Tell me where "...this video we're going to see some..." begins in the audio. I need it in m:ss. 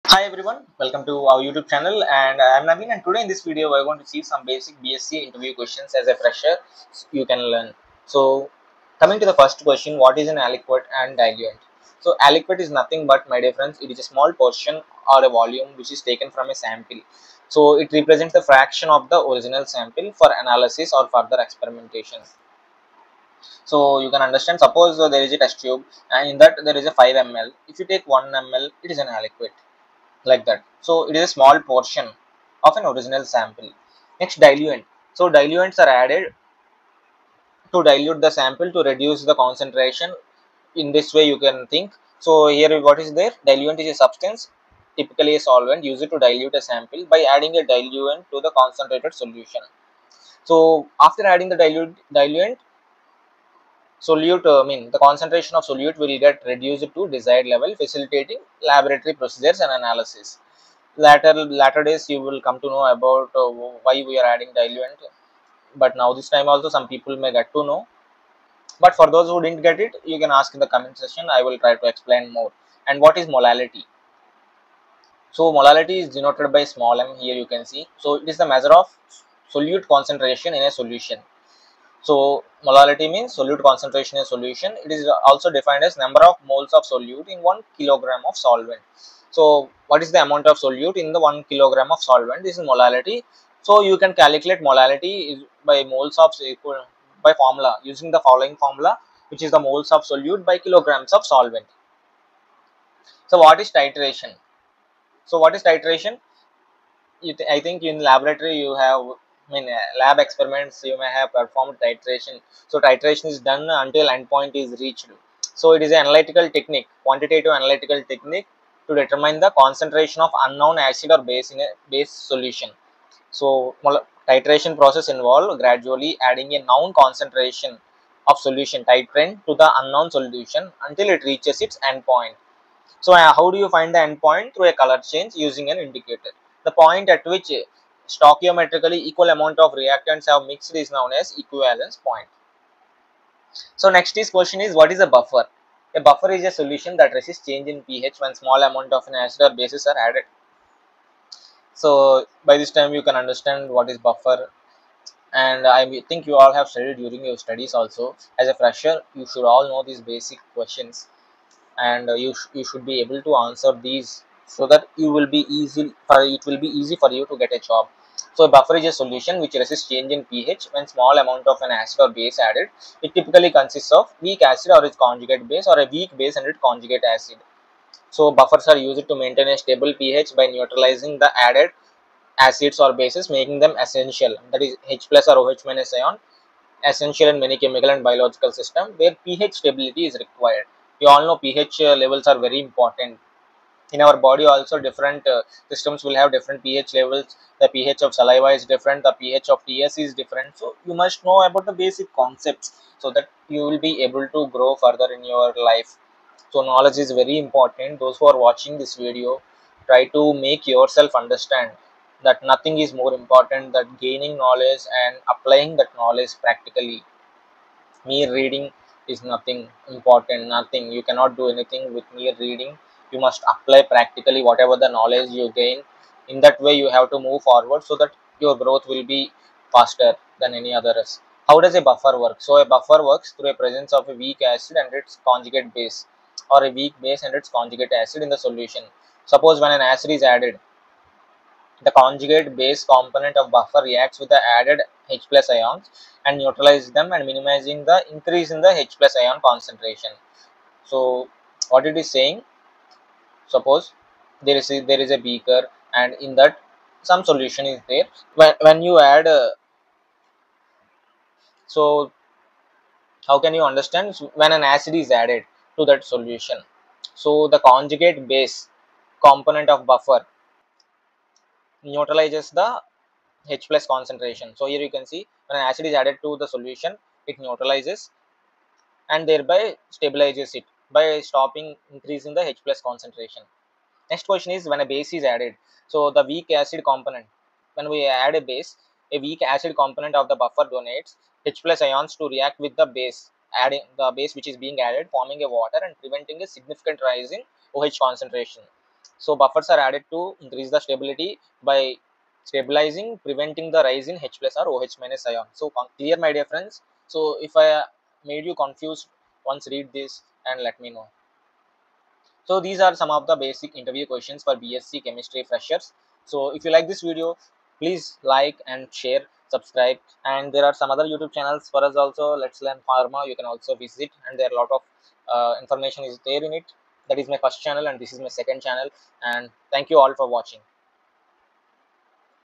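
0:03.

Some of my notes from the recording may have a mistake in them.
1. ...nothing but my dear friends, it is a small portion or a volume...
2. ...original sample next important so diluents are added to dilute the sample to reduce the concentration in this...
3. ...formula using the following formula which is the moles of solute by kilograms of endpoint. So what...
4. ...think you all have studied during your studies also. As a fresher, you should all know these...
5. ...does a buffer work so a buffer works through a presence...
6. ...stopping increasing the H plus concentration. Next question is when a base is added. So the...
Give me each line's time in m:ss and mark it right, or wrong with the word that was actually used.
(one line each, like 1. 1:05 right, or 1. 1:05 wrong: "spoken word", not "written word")
1. 0:12 right
2. 0:32 wrong: "diluent", not "important"
3. 1:37 wrong: "solvent", not "endpoint"
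4. 2:36 right
5. 3:51 right
6. 4:41 right.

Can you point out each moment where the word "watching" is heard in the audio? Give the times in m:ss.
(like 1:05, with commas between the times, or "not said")
3:28, 5:30.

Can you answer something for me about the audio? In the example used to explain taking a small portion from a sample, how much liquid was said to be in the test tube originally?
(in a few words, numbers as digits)
5 ml.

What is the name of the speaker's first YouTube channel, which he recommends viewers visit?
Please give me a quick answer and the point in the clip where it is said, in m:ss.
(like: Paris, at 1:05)
Let's Learn Pharma, at 5:22.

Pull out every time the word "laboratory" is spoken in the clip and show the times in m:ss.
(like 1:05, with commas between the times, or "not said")
0:58, 1:47.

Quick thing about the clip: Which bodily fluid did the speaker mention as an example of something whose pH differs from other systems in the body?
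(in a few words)
saliva.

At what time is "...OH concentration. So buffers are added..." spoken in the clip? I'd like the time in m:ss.
4:57.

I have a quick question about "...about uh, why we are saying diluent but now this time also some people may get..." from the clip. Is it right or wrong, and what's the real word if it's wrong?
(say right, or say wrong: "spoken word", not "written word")
wrong: "adding", not "saying".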